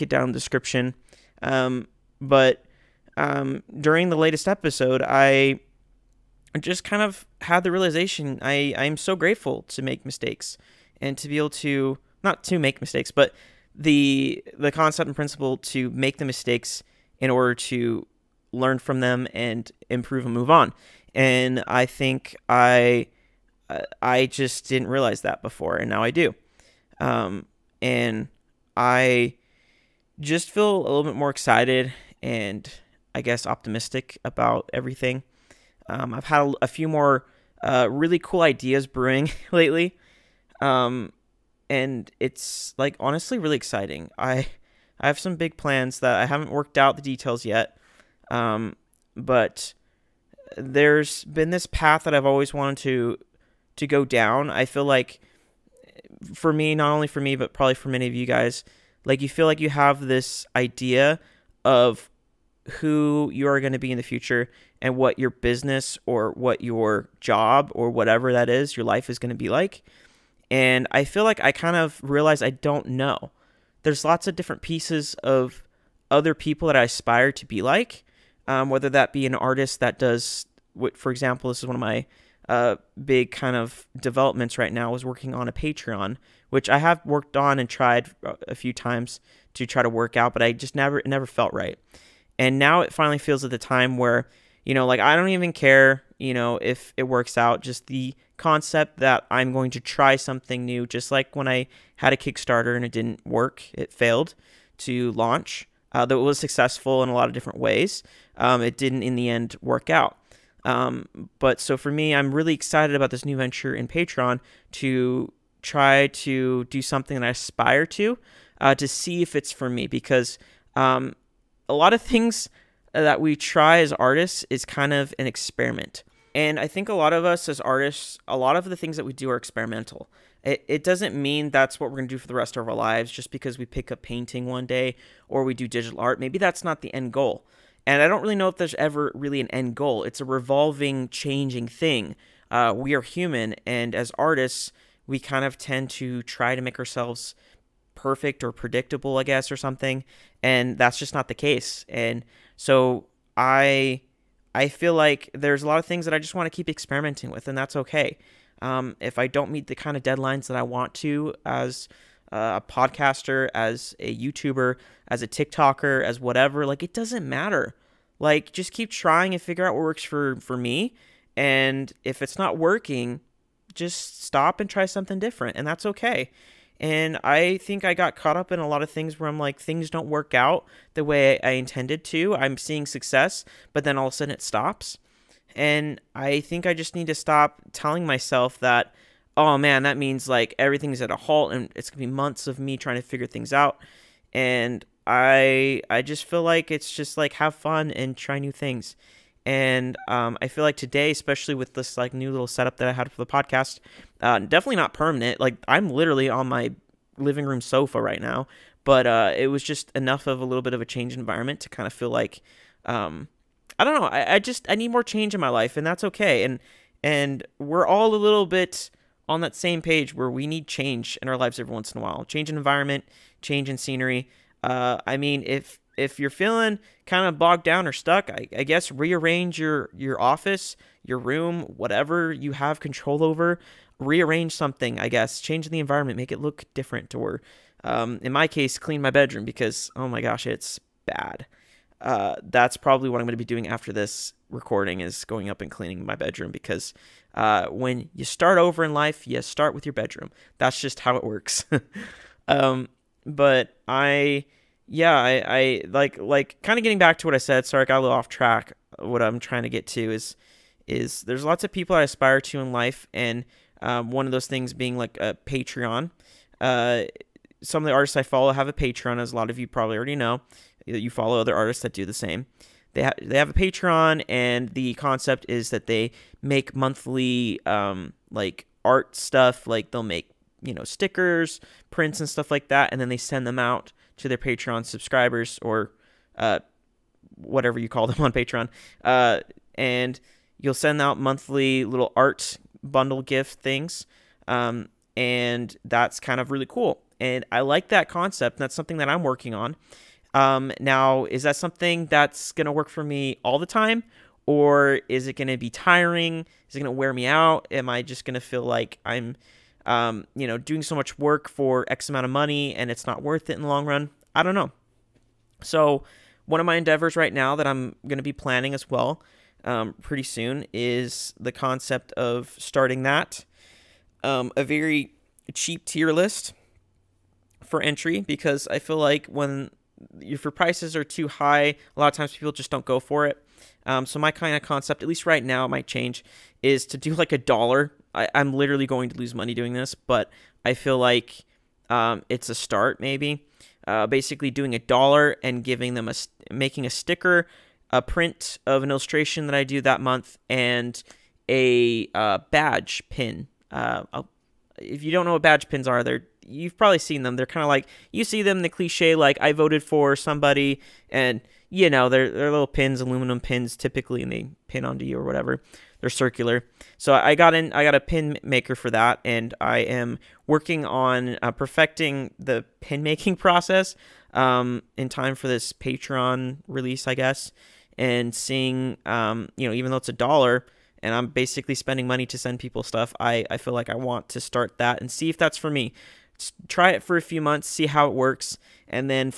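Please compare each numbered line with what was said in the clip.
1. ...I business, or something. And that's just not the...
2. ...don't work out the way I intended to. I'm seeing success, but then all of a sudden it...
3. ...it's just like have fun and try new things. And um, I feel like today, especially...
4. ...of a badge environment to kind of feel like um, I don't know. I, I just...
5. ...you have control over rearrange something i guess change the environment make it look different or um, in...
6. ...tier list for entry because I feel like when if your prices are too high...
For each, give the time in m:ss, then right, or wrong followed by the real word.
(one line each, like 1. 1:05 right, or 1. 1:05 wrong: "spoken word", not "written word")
1. 2:29 wrong: "guess", not "business"
2. 2:59 right
3. 3:16 right
4. 3:30 wrong: "change", not "badge"
5. 3:52 right
6. 5:25 right.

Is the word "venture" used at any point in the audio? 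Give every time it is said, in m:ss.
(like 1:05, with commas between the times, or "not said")
1:53.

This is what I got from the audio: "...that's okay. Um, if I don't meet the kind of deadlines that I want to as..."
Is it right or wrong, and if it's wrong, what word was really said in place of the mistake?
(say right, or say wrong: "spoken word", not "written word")
right.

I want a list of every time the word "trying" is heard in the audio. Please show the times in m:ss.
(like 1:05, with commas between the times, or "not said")
2:48, 3:12, 4:19.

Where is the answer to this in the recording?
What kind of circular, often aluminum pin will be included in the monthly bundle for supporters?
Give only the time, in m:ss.
5:52.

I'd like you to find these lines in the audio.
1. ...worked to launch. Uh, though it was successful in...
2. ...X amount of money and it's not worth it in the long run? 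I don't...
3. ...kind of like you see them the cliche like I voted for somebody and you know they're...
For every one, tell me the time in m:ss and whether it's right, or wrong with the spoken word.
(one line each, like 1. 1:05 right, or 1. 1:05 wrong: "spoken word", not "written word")
1. 1:43 wrong: "failed", not "worked"
2. 5:11 right
3. 5:57 right.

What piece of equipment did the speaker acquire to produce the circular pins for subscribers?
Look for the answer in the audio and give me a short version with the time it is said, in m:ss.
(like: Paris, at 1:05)
Pin maker, at 6:07.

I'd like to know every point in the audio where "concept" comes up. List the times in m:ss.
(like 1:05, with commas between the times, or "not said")
0:14, 1:38, 4:34, 4:58, 5:21, 5:34.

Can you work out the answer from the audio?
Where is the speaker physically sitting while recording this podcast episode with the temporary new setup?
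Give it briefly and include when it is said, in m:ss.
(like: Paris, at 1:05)
Living room sofa, at 3:27.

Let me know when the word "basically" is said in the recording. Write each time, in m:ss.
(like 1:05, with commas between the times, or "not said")
5:44, 6:21.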